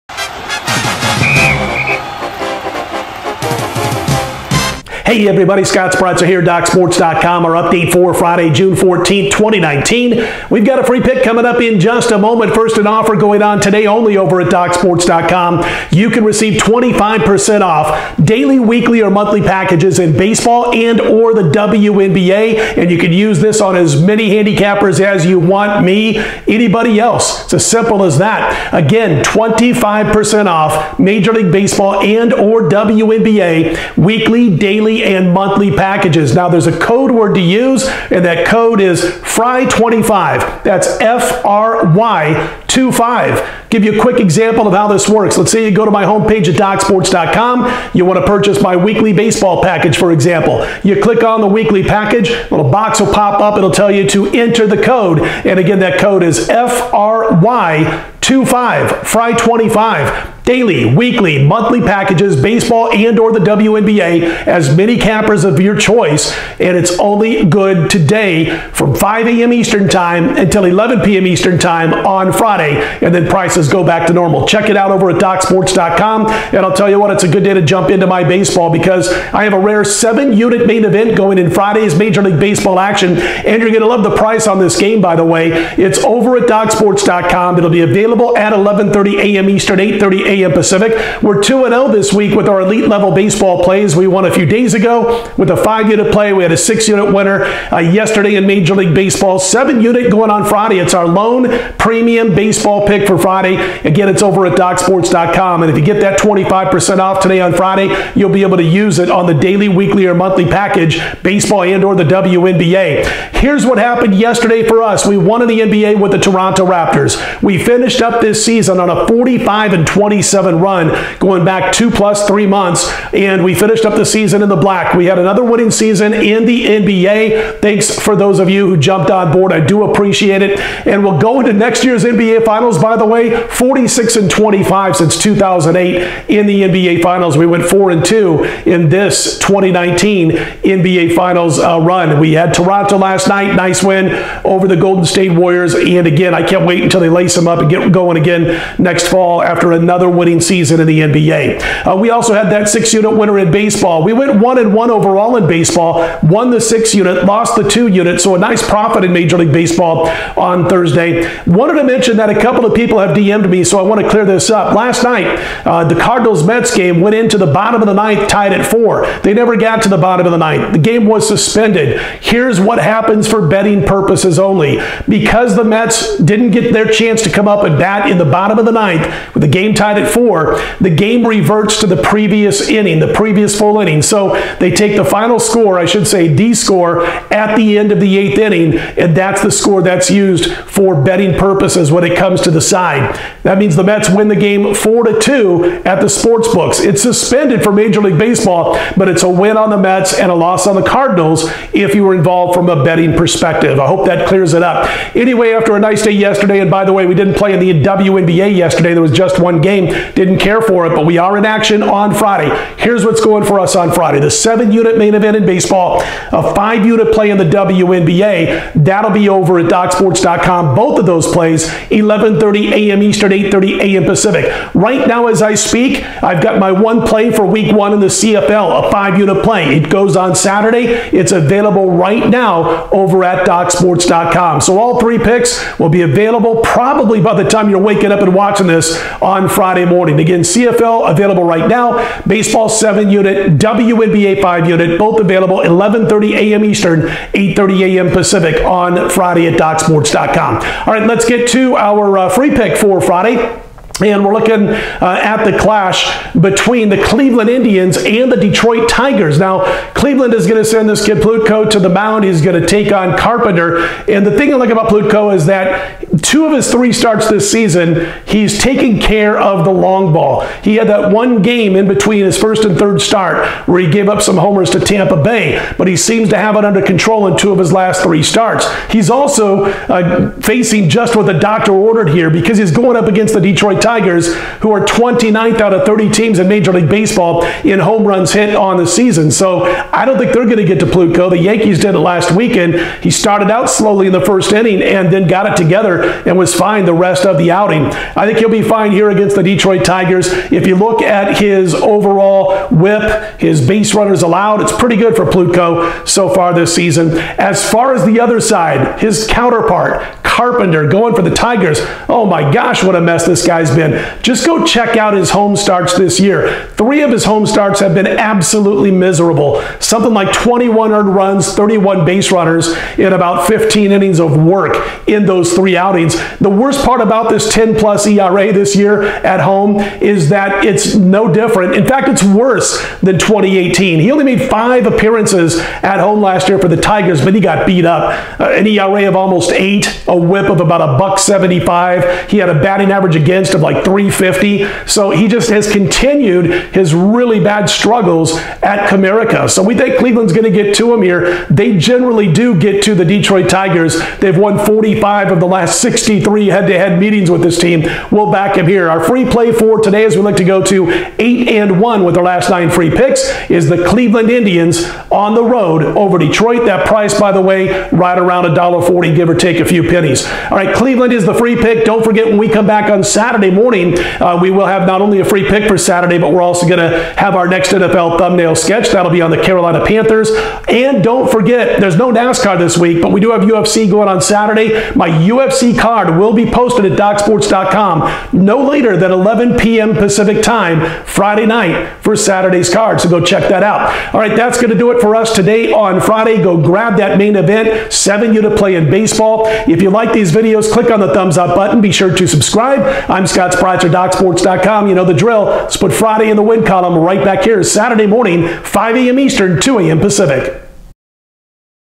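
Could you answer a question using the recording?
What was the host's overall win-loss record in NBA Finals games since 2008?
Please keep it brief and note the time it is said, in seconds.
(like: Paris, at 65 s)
46 and 25, at 133 s.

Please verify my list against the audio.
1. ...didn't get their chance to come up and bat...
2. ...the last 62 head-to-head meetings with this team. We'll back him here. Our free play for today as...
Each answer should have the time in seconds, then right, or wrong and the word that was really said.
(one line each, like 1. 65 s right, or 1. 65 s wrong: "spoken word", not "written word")
1. 176 s right
2. 355 s wrong: "63", not "62".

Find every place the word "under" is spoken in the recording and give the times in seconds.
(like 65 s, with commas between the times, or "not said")
276 s.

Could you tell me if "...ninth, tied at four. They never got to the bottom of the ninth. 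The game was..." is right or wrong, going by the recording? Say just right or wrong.
right.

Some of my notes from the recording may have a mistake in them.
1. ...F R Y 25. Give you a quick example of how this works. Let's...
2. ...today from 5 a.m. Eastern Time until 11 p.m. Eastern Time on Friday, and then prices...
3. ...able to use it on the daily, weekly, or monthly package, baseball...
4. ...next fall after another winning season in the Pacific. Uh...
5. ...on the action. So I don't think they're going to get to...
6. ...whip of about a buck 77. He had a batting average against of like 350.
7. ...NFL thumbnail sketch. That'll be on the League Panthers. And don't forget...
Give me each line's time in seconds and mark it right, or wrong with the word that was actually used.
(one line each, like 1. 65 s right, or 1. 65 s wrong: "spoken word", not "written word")
1. 41 s right
2. 67 s right
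3. 108 s right
4. 148 s wrong: "NBA", not "Pacific"
5. 288 s wrong: "season", not "action"
6. 340 s wrong: "75", not "77"
7. 377 s wrong: "Carolina", not "League".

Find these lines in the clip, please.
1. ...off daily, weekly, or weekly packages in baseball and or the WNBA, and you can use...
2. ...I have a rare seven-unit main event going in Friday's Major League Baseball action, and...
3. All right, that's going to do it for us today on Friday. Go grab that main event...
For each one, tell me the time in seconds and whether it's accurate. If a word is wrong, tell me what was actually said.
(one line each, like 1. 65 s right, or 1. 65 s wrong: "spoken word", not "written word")
1. 17 s wrong: "monthly", not "weekly"
2. 79 s right
3. 394 s right.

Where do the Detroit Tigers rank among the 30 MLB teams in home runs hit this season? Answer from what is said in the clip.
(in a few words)
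29th.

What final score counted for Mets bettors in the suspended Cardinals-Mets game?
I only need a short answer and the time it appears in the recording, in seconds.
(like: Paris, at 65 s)
4 to 2, at 194 s.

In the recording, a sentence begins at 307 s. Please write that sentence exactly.
As far as the other side, his counterpart, Carpenter, going for the Tigers.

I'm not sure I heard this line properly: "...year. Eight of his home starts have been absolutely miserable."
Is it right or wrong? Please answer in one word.
wrong.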